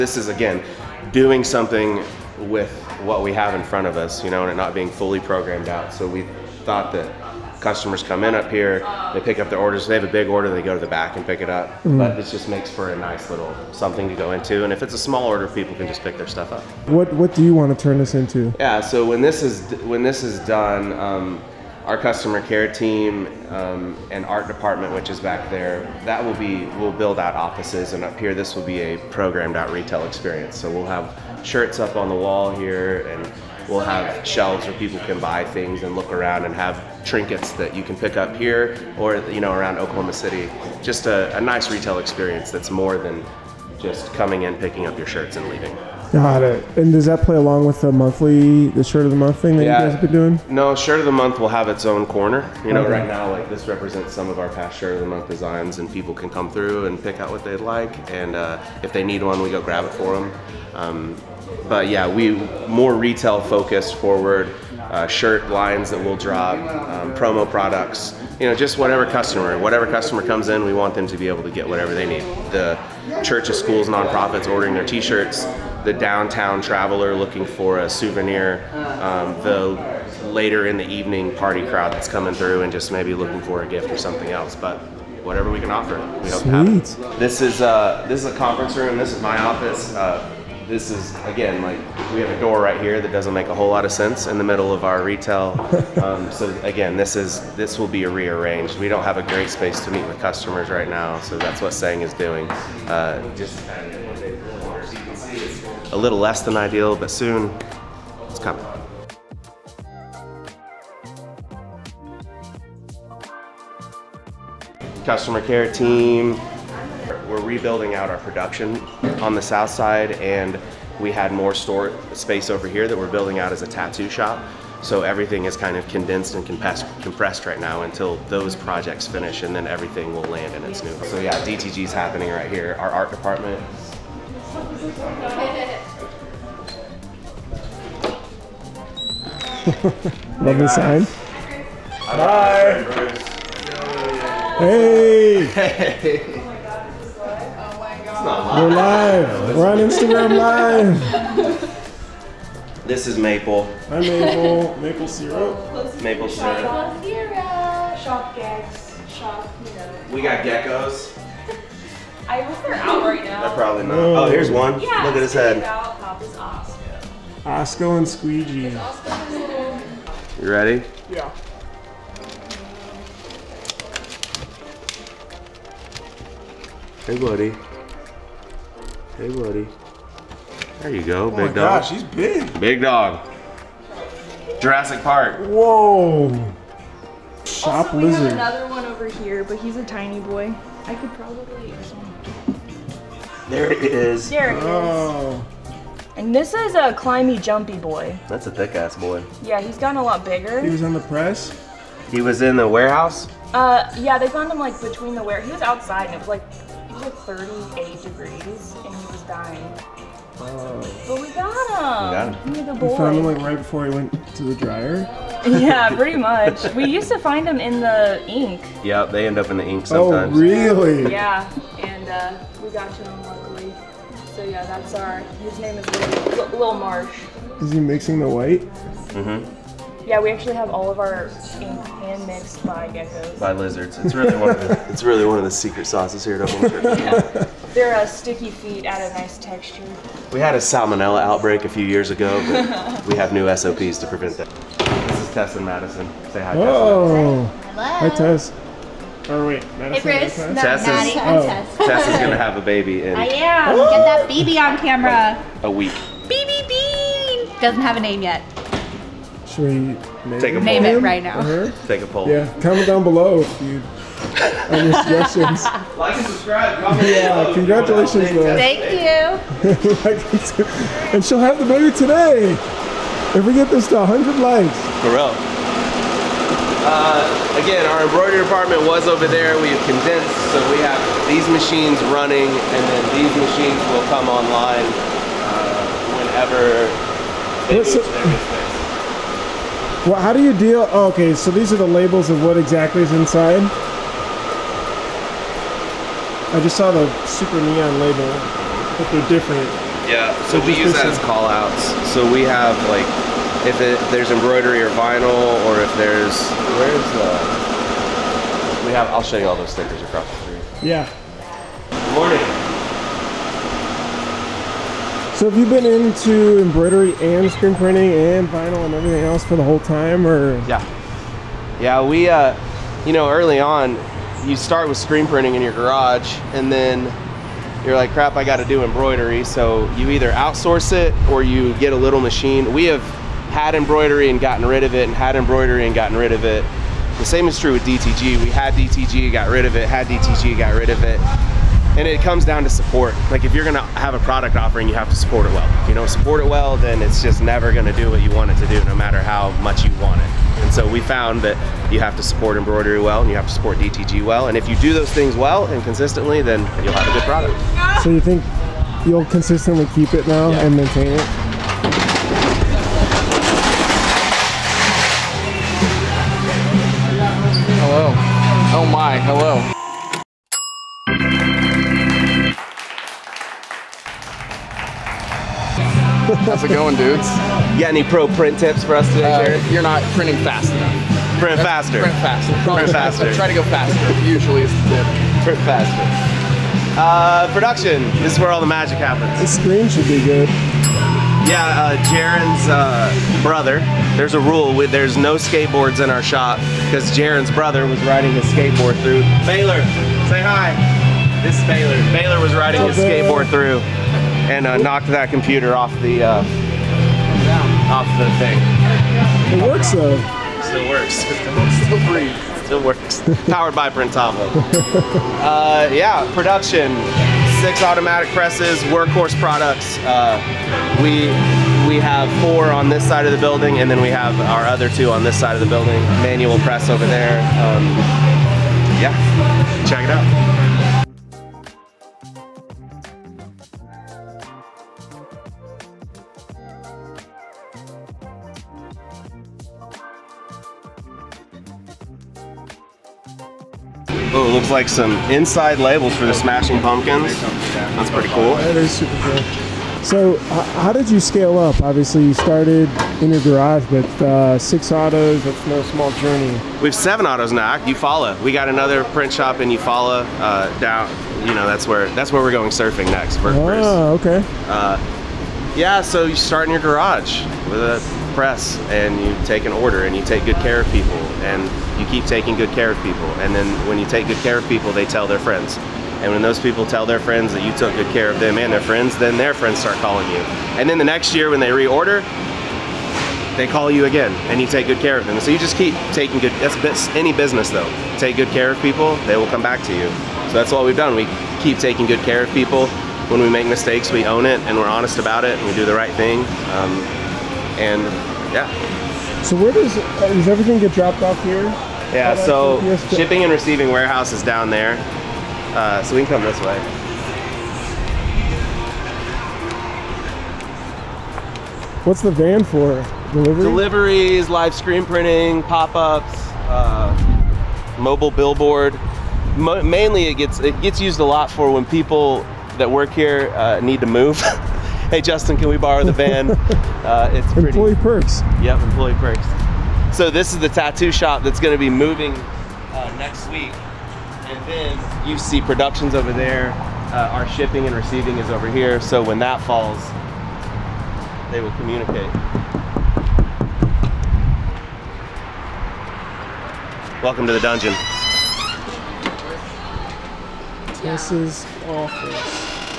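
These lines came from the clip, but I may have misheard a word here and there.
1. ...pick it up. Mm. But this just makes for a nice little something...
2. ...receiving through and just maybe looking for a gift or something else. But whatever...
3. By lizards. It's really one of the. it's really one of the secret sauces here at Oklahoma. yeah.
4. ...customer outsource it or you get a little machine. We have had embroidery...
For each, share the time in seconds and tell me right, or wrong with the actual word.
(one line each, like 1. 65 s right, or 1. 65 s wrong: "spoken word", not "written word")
1. 11 s right
2. 82 s wrong: "coming", not "receiving"
3. 233 s right
4. 330 s wrong: "either", not "customer".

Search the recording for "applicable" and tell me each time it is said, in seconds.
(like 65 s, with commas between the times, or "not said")
not said.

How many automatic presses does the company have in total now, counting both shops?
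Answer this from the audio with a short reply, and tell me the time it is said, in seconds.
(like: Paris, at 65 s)
7, at 456 s.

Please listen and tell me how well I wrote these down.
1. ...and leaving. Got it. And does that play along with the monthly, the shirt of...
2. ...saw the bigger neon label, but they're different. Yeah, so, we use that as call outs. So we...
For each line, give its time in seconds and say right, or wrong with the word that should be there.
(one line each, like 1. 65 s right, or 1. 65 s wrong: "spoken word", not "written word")
1. 45 s right
2. 296 s wrong: "super", not "bigger".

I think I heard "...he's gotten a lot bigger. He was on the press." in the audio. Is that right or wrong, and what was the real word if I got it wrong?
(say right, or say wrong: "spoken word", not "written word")
right.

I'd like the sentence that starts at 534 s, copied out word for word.
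And then you see productions over there.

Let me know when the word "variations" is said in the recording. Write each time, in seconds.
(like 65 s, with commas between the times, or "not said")
not said.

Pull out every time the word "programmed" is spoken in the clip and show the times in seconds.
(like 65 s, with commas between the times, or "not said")
5 s, 29 s.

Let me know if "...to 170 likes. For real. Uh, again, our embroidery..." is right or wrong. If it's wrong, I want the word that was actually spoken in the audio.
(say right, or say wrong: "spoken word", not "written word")
wrong: "100", not "170".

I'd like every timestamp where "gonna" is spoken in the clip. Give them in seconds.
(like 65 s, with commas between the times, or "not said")
343 s, 347 s.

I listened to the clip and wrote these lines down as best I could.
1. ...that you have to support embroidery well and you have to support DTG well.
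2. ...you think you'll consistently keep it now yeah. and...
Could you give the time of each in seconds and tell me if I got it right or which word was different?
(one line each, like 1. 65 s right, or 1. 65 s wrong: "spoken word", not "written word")
1. 351 s right
2. 358 s right.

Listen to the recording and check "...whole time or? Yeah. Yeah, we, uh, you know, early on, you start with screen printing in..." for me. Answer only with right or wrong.
right.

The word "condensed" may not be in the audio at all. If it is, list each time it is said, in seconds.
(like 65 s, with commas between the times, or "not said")
125 s, 279 s.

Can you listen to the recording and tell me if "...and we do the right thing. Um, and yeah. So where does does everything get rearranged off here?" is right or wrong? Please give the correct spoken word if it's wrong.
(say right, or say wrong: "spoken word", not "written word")
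wrong: "dropped", not "rearranged".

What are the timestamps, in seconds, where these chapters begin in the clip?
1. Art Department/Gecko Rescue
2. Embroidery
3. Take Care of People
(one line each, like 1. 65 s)
1. 130 s
2. 274 s
3. 448 s.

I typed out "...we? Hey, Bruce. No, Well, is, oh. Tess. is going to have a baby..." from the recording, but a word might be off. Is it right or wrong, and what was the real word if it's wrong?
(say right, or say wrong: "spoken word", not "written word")
wrong: "Tess", not "Well".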